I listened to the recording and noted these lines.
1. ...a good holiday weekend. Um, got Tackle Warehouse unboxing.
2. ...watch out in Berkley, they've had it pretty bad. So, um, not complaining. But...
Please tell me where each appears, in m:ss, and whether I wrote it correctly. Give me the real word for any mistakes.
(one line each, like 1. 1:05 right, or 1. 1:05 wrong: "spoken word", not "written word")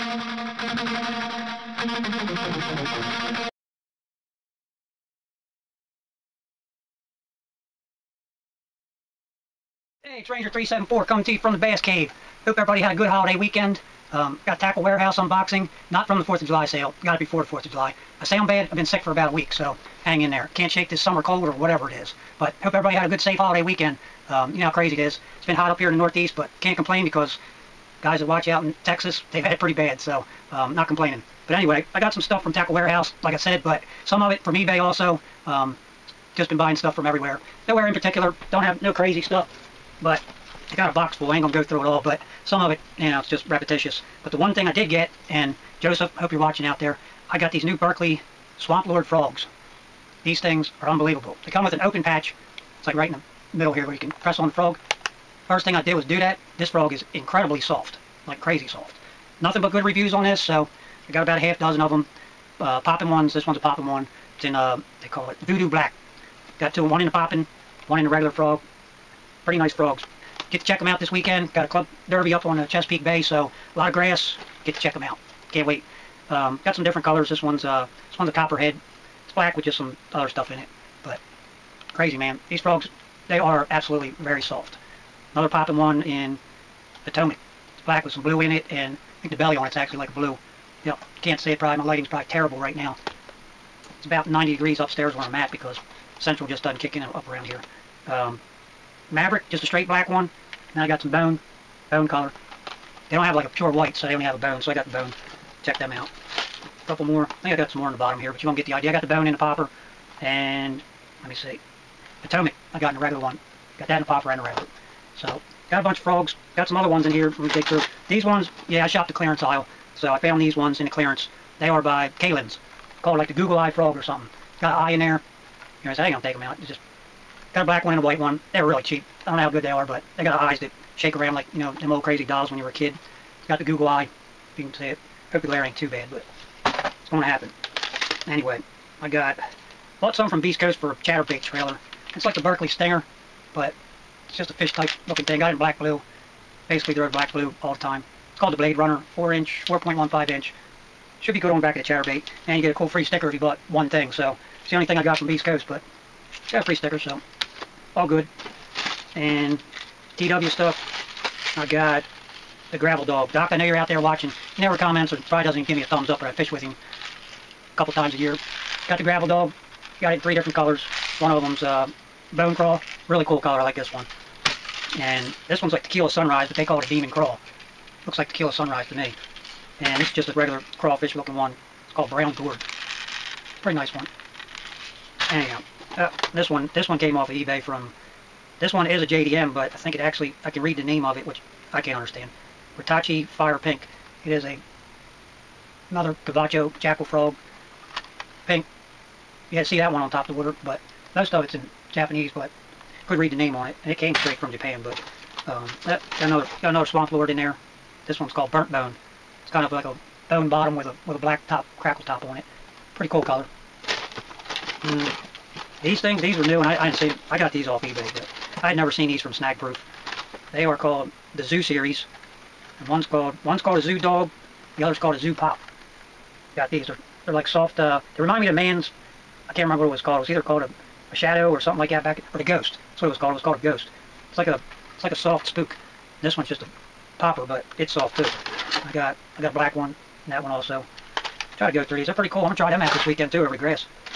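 1. 0:12 right
2. 0:28 wrong: "Texas", not "Berkley".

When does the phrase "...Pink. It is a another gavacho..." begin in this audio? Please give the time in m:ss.
3:13.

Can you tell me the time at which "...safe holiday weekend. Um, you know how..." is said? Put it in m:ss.
0:23.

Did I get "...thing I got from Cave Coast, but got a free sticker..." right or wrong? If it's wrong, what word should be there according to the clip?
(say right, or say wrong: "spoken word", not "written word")
wrong: "Beast", not "Cave".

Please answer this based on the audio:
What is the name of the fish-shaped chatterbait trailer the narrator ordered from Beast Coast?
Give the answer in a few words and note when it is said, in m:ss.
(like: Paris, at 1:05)
Blade Runner, at 2:28.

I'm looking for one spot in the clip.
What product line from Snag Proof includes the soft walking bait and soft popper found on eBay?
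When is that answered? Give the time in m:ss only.
3:41.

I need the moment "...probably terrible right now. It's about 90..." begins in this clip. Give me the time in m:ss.
1:32.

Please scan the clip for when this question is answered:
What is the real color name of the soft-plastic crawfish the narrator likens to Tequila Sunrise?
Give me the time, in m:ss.
2:56.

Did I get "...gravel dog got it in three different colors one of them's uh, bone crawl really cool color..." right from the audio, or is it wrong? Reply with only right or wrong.
right.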